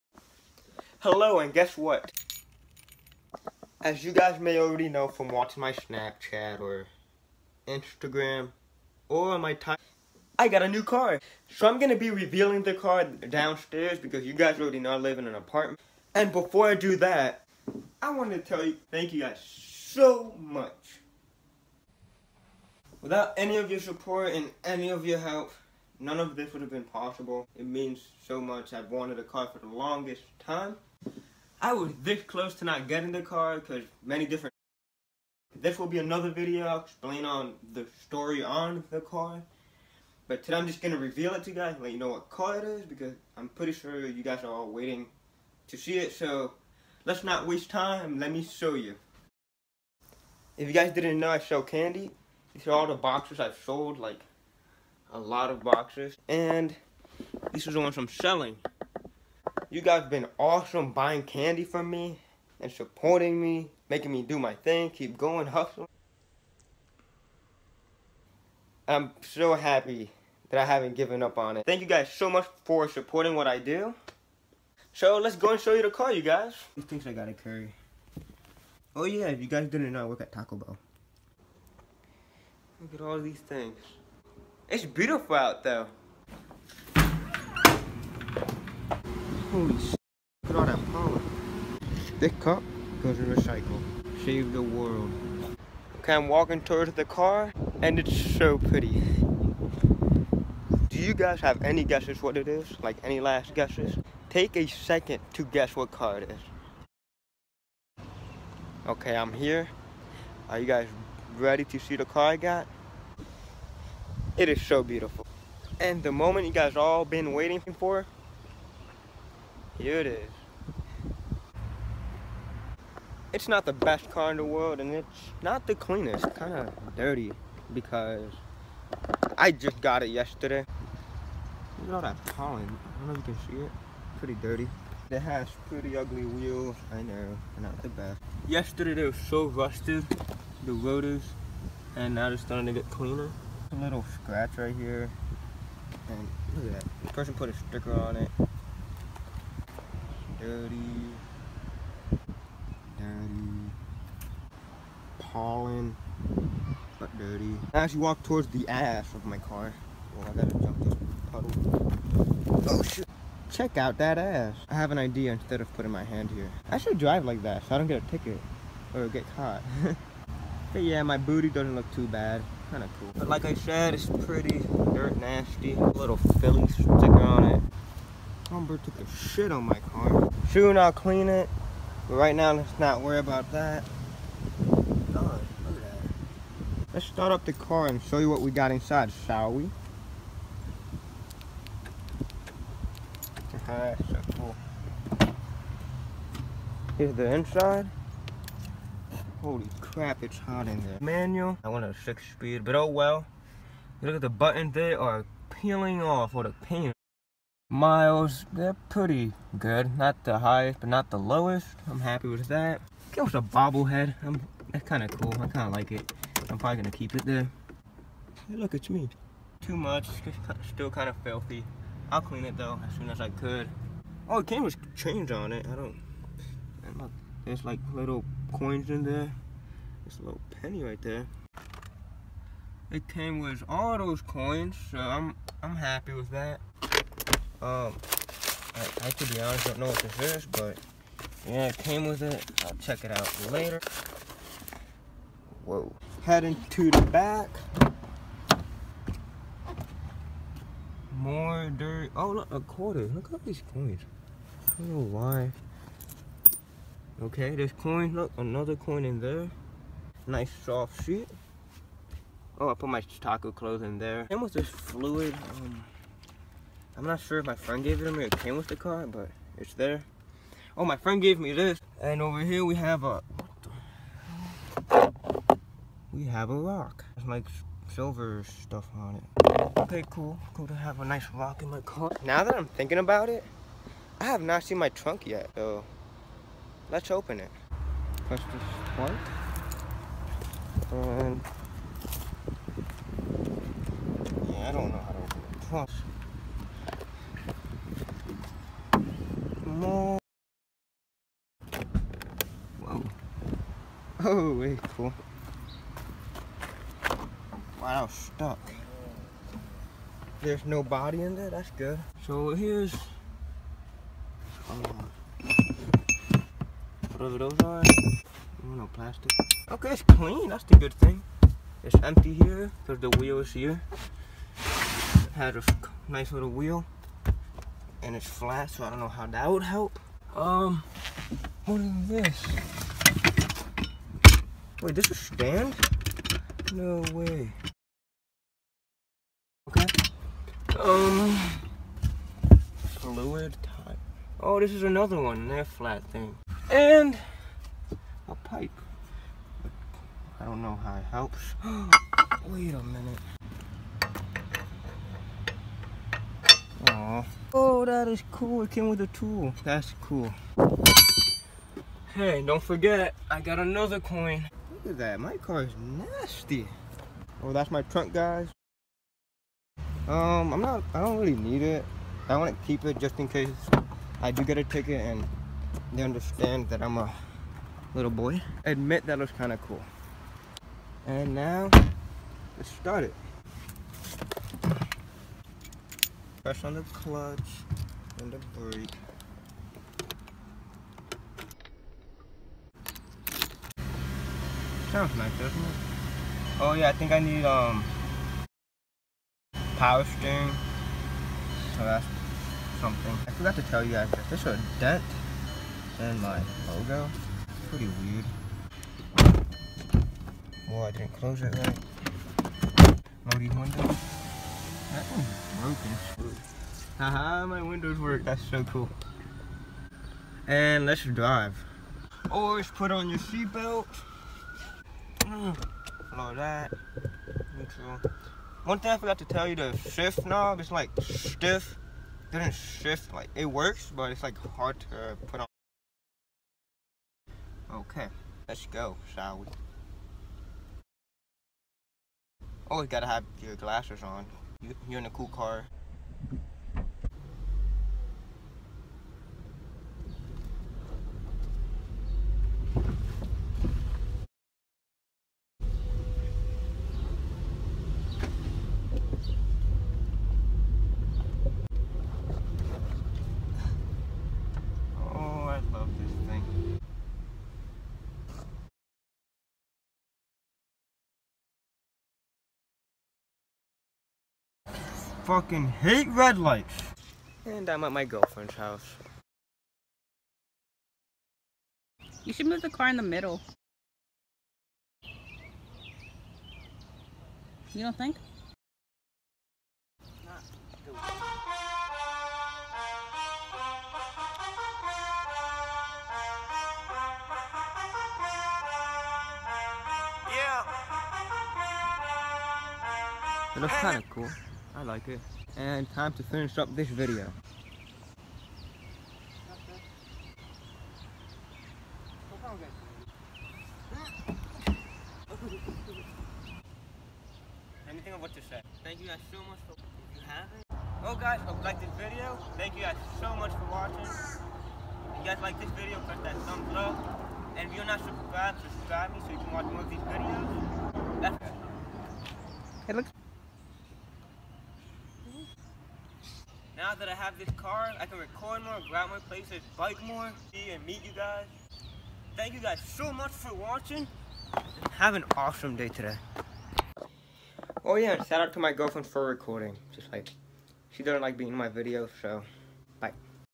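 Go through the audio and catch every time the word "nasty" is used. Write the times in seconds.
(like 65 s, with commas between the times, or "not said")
175 s, 366 s.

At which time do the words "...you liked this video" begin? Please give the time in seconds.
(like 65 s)
521 s.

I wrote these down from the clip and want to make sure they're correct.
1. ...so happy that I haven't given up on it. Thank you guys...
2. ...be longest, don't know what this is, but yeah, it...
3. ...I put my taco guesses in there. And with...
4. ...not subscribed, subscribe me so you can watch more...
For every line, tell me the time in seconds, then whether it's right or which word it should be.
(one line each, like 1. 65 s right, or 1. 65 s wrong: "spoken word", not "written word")
1. 69 s right
2. 239 s wrong: "honest", not "longest"
3. 262 s wrong: "clothes", not "guesses"
4. 527 s right.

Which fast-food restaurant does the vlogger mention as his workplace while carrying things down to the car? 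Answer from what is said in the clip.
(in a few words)
Taco Bell.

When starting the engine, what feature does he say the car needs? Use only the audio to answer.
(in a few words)
Power steering.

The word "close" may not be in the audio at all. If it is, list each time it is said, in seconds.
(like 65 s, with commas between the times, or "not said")
32 s, 411 s.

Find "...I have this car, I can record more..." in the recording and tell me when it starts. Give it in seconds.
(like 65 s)
537 s.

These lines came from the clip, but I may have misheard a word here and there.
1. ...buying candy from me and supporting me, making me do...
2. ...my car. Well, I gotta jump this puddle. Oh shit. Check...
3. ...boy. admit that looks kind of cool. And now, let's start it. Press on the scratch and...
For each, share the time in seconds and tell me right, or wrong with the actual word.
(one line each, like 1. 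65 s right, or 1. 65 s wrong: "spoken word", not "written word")
1. 60 s right
2. 159 s right
3. 378 s wrong: "clutch", not "scratch".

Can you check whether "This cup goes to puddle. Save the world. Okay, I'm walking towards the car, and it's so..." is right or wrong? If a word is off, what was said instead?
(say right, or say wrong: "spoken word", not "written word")
wrong: "recycle", not "puddle".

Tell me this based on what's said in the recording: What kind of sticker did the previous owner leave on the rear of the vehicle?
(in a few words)
Philly sticker.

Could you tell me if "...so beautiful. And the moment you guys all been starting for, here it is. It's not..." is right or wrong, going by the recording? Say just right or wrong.
wrong.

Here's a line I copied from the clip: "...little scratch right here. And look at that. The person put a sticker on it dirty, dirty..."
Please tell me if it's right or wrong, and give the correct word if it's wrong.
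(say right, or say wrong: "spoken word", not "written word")
right.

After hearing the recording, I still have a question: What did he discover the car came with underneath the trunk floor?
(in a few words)
A tool.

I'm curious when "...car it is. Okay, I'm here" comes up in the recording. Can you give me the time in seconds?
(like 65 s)
105 s.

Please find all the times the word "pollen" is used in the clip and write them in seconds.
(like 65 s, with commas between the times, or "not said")
132 s, 155 s.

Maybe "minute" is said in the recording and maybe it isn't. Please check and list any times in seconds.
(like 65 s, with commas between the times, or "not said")
352 s.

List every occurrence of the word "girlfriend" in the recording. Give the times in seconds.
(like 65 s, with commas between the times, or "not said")
478 s, 548 s.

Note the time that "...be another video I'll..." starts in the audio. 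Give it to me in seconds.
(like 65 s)
35 s.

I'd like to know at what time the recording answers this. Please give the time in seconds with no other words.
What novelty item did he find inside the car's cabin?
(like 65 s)
213 s.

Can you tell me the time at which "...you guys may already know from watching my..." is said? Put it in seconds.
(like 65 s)
4 s.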